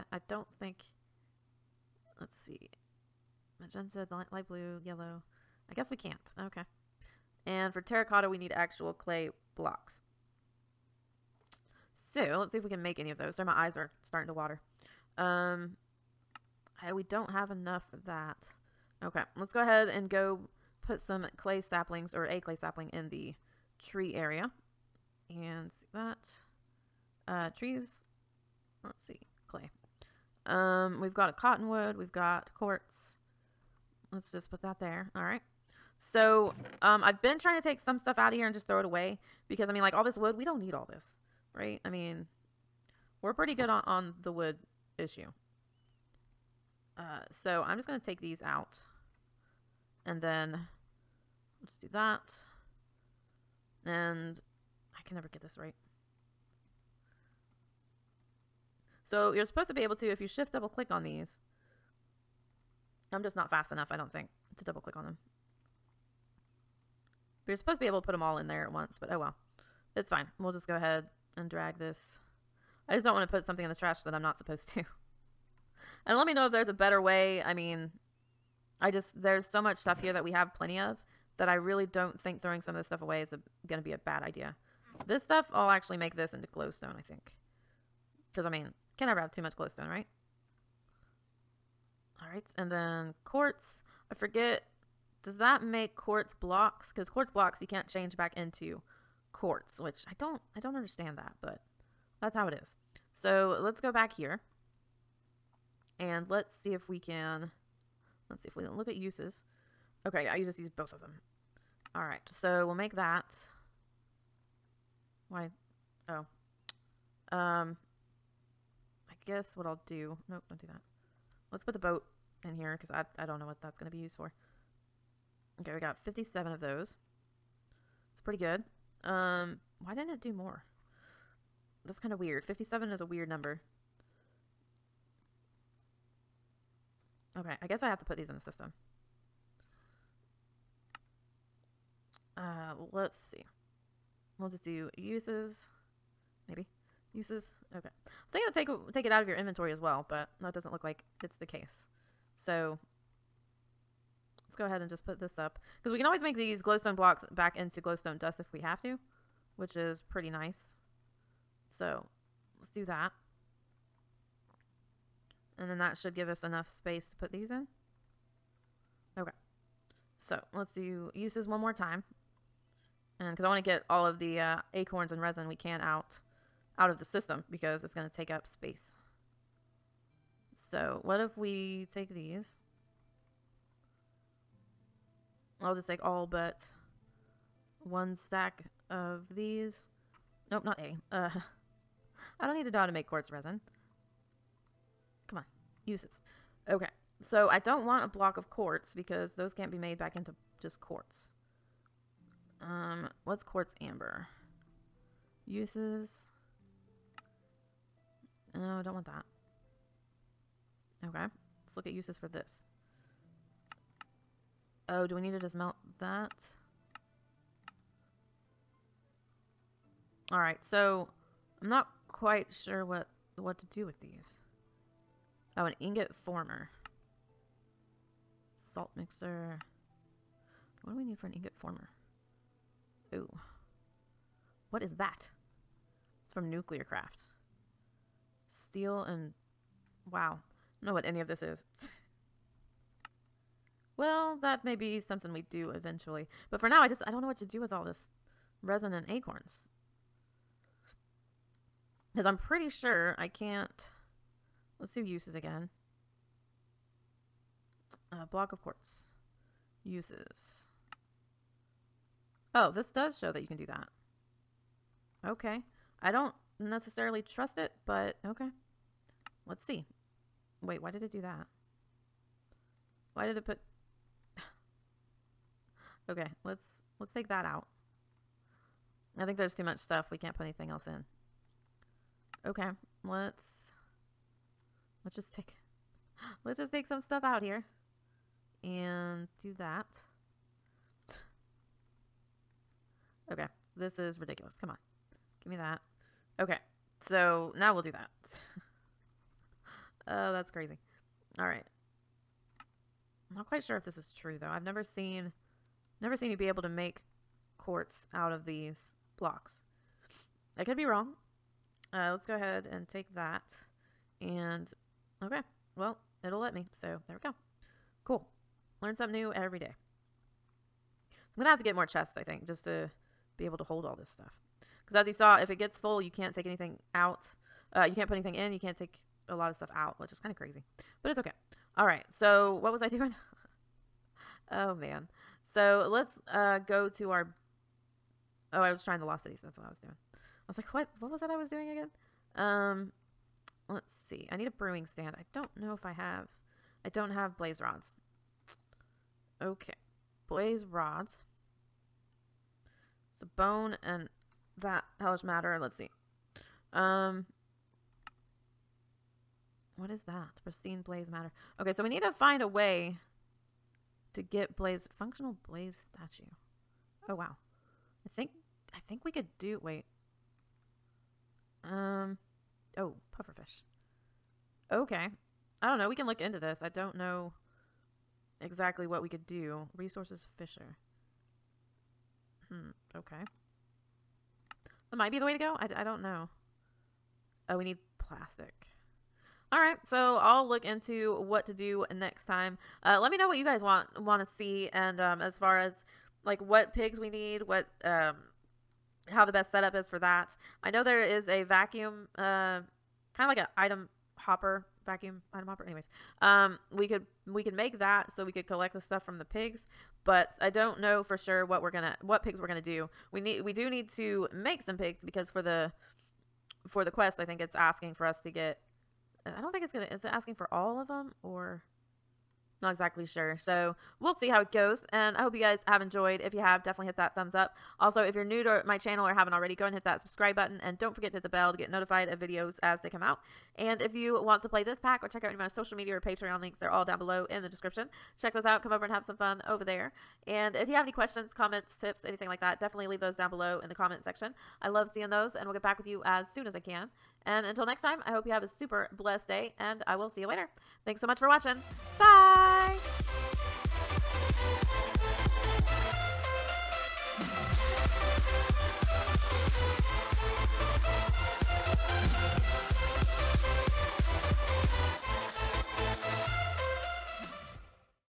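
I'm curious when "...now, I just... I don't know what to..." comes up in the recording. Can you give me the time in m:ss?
4:06.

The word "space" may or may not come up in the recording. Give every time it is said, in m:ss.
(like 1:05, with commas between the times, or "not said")
2:46, 2:58.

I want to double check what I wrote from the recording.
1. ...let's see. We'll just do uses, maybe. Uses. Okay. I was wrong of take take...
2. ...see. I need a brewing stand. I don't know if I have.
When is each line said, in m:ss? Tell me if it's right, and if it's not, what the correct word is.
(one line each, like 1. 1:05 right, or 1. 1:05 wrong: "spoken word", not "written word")
1. 2:22 wrong: "thinking", not "wrong"
2. 5:44 right.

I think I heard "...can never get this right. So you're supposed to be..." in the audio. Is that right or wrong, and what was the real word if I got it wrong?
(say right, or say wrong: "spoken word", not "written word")
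right.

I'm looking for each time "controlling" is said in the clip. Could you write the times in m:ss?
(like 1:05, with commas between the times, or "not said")
not said.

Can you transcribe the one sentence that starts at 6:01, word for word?
Okay, so we need to find a way to get blaze functional blaze statue.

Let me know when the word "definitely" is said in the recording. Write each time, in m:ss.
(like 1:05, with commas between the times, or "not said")
7:06, 7:22.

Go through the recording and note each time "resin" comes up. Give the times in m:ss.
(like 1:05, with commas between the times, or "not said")
2:55, 3:13, 4:08.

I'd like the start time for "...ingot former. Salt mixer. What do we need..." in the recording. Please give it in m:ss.
3:45.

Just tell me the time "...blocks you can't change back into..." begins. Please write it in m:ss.
1:37.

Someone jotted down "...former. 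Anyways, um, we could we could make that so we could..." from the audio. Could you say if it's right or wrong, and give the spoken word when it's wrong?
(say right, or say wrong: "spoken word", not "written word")
wrong: "hopper", not "former".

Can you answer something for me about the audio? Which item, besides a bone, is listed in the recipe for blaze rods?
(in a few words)
Hellish matter.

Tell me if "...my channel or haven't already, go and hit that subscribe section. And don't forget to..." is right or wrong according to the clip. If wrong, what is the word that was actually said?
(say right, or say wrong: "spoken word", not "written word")
wrong: "button", not "section".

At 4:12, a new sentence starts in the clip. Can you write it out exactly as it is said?
Because I'm pretty sure I can't.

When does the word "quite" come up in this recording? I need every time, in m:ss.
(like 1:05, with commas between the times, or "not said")
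3:42, 5:03.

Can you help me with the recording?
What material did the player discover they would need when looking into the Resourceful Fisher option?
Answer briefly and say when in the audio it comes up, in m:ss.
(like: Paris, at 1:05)
Plastic, at 6:27.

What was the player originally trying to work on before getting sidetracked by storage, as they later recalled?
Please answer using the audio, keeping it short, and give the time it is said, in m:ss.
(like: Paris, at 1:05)
The Lost Cities, at 5:39.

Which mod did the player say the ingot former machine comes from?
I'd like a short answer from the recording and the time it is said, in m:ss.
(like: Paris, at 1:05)
NuclearCraft, at 3:56.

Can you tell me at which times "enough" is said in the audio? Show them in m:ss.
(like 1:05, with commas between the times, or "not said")
0:17, 1:03, 2:46.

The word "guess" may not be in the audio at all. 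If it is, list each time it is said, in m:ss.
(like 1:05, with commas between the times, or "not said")
0:05, 1:59, 2:17.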